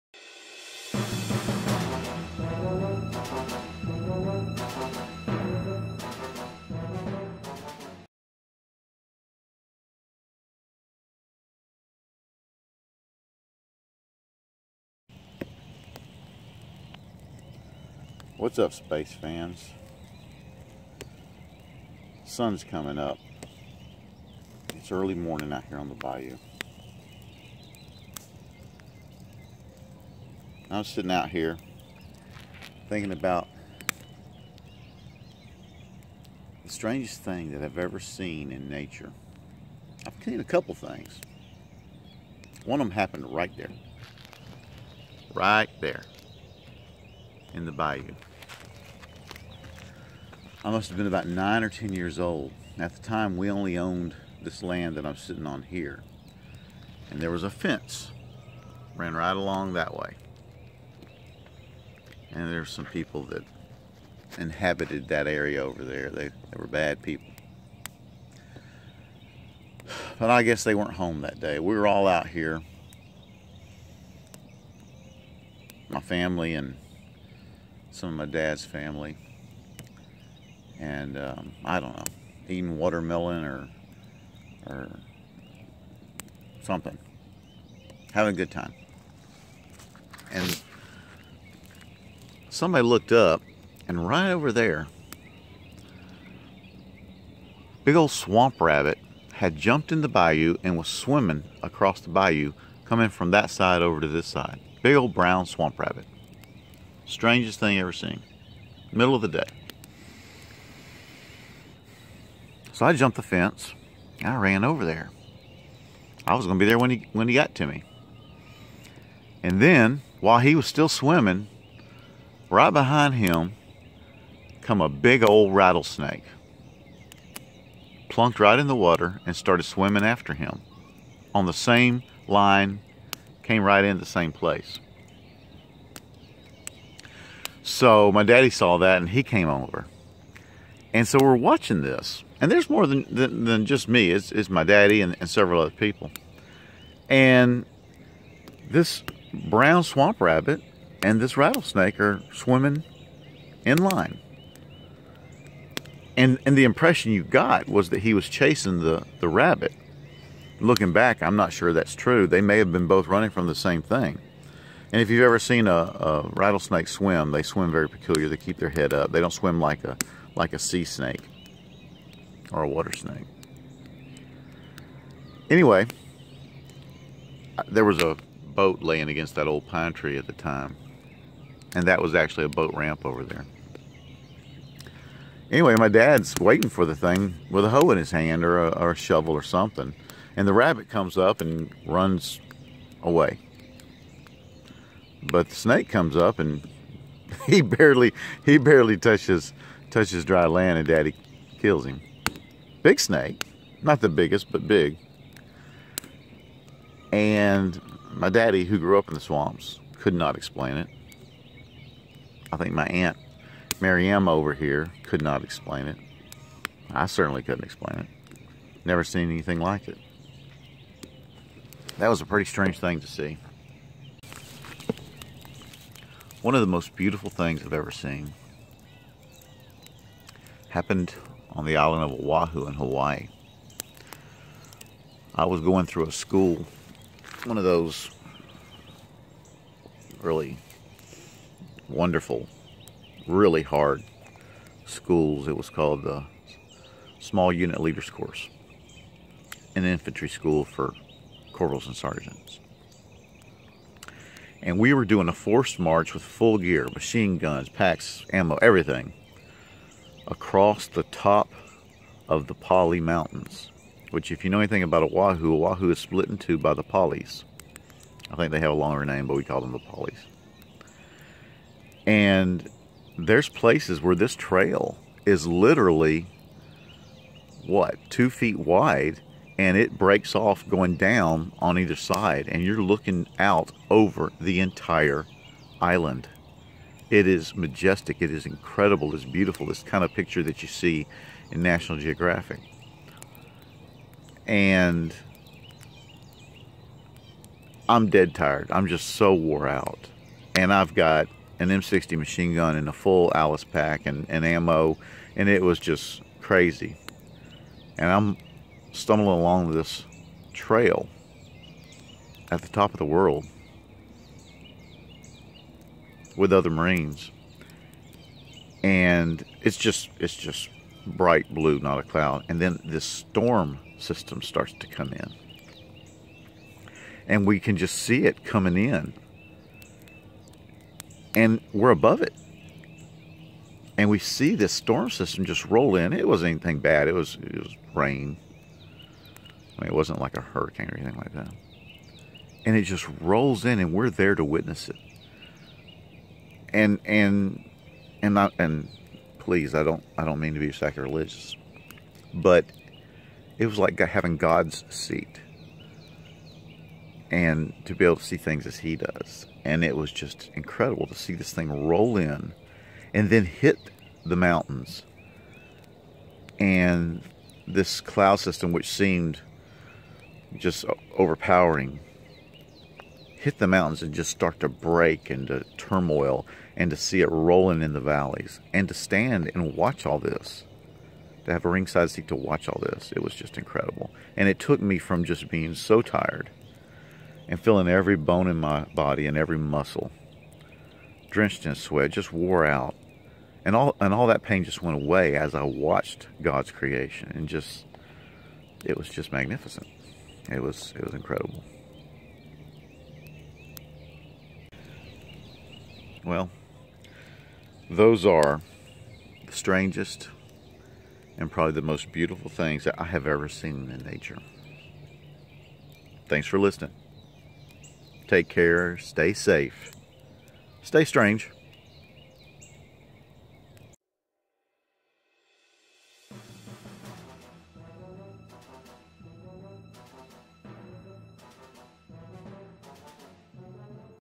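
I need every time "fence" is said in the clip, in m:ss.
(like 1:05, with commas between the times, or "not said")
0:57, 1:53.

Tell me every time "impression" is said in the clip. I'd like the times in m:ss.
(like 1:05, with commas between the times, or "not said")
2:36.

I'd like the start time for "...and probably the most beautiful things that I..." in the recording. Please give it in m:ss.
6:51.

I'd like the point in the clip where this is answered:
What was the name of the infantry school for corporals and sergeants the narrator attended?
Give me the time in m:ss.
4:07.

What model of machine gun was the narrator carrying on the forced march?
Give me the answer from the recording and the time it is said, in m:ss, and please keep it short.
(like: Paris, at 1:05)
M60, at 5:01.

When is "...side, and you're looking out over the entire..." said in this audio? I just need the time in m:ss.
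4:41.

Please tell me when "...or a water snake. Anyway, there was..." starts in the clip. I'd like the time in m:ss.
2:52.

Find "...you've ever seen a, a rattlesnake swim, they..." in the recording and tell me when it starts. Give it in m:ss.
2:45.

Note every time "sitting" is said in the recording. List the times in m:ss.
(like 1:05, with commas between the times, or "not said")
0:30, 0:55.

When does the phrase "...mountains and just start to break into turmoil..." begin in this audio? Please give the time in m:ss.
6:13.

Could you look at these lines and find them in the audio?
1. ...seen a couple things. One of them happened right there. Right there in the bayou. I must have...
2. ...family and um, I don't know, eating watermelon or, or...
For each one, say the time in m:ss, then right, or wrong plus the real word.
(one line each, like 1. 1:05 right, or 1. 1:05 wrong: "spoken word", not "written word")
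1. 0:40 right
2. 1:18 right.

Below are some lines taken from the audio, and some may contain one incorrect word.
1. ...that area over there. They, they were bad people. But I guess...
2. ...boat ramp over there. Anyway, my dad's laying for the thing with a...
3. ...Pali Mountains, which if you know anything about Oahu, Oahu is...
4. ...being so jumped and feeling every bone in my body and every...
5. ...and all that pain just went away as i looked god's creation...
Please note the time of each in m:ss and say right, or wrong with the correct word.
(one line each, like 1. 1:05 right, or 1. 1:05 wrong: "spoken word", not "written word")
1. 1:05 right
2. 3:02 wrong: "waiting", not "laying"
3. 4:22 right
4. 6:25 wrong: "tired", not "jumped"
5. 6:33 wrong: "watched", not "looked".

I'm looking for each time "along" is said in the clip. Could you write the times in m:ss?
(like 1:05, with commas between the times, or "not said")
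0:59, 5:09.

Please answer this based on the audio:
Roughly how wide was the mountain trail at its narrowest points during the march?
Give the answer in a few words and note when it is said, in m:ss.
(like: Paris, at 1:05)
2 feet, at 4:38.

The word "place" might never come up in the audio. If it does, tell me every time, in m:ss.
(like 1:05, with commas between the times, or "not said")
2:14, 4:33.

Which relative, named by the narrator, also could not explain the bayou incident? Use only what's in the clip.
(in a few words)
Maryam.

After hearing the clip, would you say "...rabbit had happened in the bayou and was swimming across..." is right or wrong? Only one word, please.
wrong.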